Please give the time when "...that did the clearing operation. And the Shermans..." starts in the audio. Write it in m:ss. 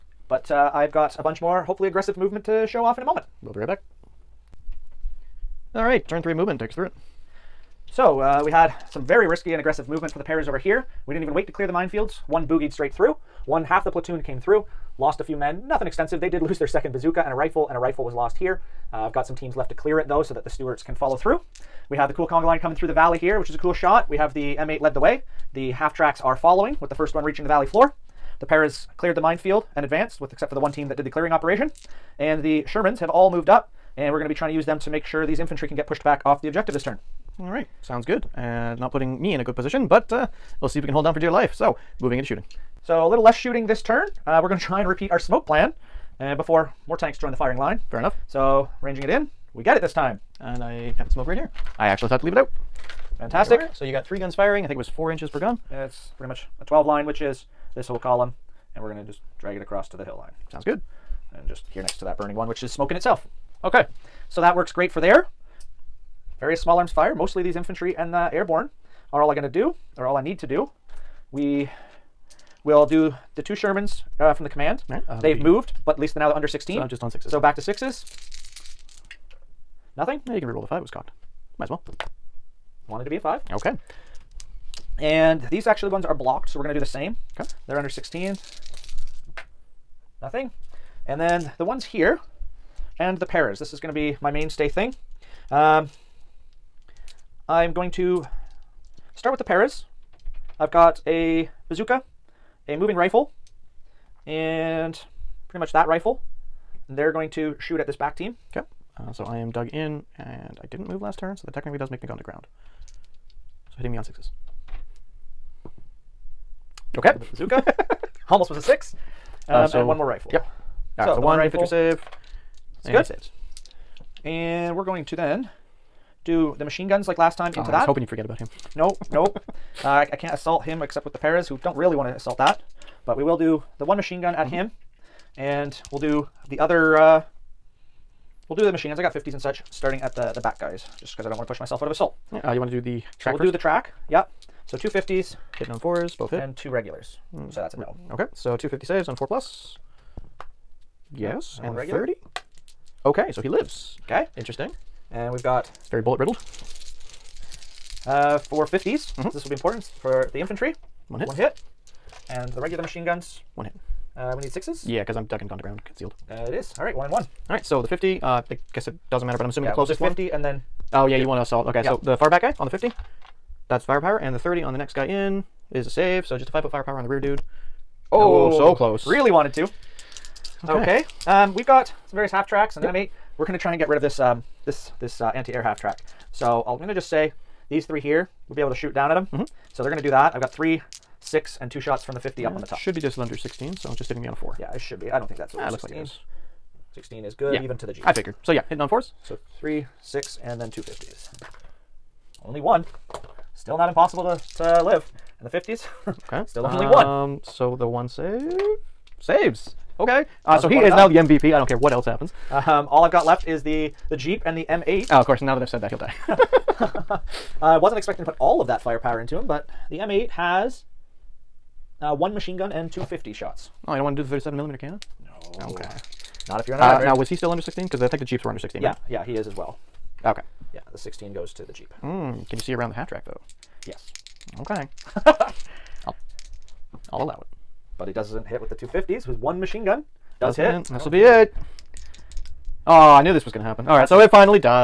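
0:30.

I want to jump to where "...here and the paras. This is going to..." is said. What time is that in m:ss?
1:31.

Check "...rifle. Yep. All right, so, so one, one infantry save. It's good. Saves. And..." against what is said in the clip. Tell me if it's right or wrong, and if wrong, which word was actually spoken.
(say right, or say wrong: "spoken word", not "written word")
right.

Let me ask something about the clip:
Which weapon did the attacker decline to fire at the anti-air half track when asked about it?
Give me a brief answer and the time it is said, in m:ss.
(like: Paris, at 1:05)
37mm cannon, at 3:44.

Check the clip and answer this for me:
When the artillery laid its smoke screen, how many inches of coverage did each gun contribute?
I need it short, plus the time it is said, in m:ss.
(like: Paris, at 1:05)
4 inches, at 0:54.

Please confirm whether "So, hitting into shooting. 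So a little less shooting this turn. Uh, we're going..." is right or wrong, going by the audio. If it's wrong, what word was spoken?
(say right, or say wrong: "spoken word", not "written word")
wrong: "moving", not "hitting".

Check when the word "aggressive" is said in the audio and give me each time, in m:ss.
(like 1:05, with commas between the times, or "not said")
0:01, 0:09.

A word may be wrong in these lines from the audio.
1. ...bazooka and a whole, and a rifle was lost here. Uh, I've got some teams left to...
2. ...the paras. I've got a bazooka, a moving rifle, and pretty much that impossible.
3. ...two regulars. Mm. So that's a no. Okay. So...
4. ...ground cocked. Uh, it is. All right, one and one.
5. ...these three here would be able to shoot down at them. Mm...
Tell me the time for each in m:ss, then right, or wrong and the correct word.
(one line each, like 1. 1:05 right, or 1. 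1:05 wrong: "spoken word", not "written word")
1. 0:16 wrong: "rifle", not "whole"
2. 1:39 wrong: "rifle", not "impossible"
3. 2:26 right
4. 2:45 wrong: "concealed", not "cocked"
5. 3:07 right.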